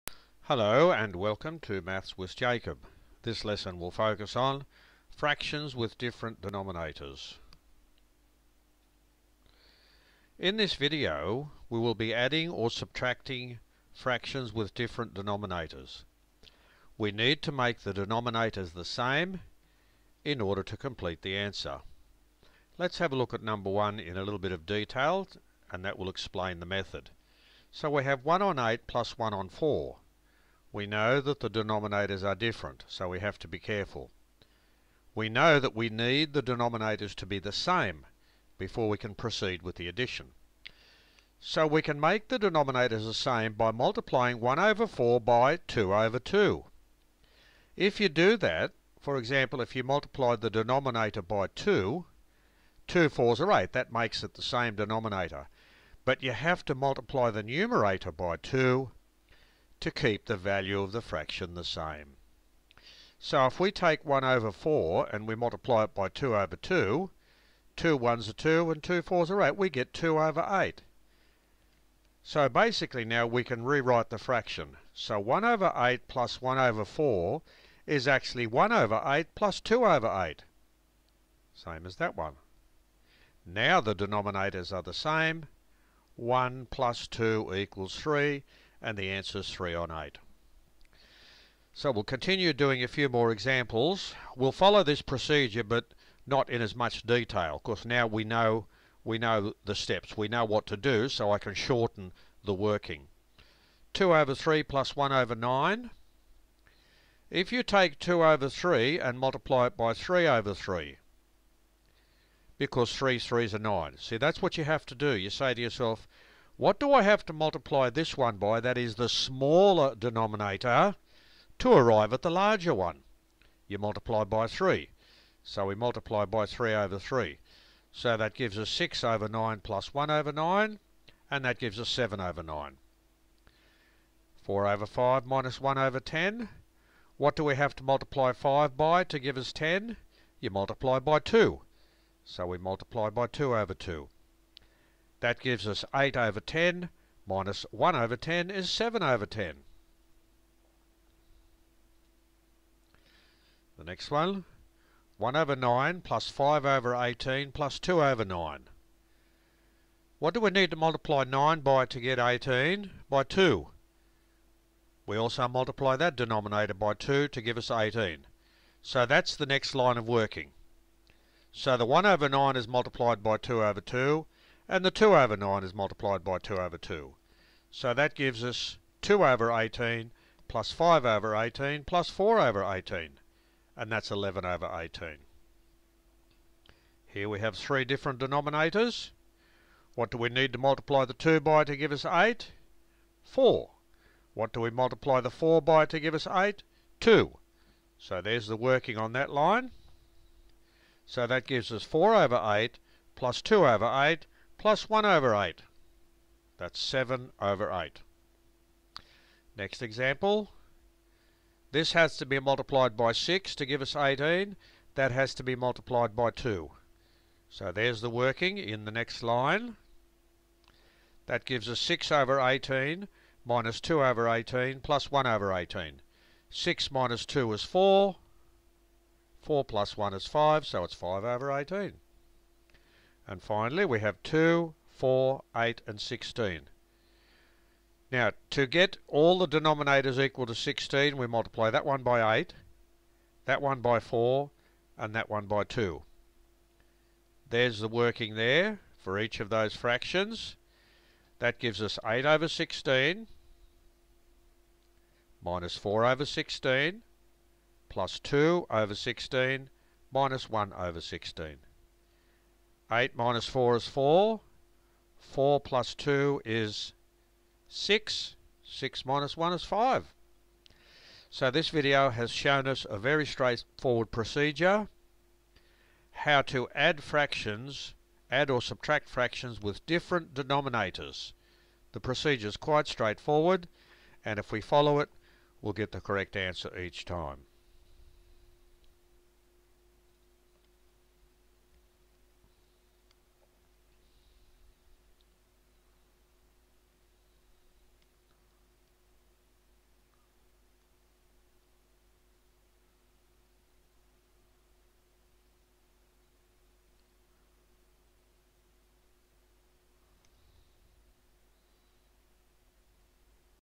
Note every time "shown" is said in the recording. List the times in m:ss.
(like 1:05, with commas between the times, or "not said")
4:32.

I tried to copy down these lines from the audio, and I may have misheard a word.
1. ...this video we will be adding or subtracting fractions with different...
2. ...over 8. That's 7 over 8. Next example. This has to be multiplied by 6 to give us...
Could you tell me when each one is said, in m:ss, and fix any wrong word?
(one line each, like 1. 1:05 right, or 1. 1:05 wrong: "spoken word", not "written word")
1. 0:10 right
2. 3:25 right.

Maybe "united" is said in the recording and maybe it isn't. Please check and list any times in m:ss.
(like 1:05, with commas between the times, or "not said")
not said.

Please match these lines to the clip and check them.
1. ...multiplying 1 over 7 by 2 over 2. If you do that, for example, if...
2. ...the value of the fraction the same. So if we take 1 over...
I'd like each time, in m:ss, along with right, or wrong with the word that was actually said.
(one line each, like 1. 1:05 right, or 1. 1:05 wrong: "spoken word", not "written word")
1. 0:43 wrong: "4", not "7"
2. 1:00 right.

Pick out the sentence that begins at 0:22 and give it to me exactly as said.
Let's have a look at number 1 in a little bit of detail and that will explain the method.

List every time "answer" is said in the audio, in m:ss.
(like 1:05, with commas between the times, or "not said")
0:21, 1:29, 4:46.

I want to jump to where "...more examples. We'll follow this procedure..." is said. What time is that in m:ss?
1:33.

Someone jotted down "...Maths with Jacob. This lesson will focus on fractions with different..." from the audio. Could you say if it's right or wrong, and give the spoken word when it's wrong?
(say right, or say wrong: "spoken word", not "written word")
right.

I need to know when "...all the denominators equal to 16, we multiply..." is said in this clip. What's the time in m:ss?
3:59.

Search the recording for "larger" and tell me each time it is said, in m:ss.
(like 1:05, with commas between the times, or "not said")
2:02.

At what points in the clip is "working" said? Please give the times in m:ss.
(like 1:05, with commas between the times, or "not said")
1:42, 2:50, 3:18, 3:38, 4:07.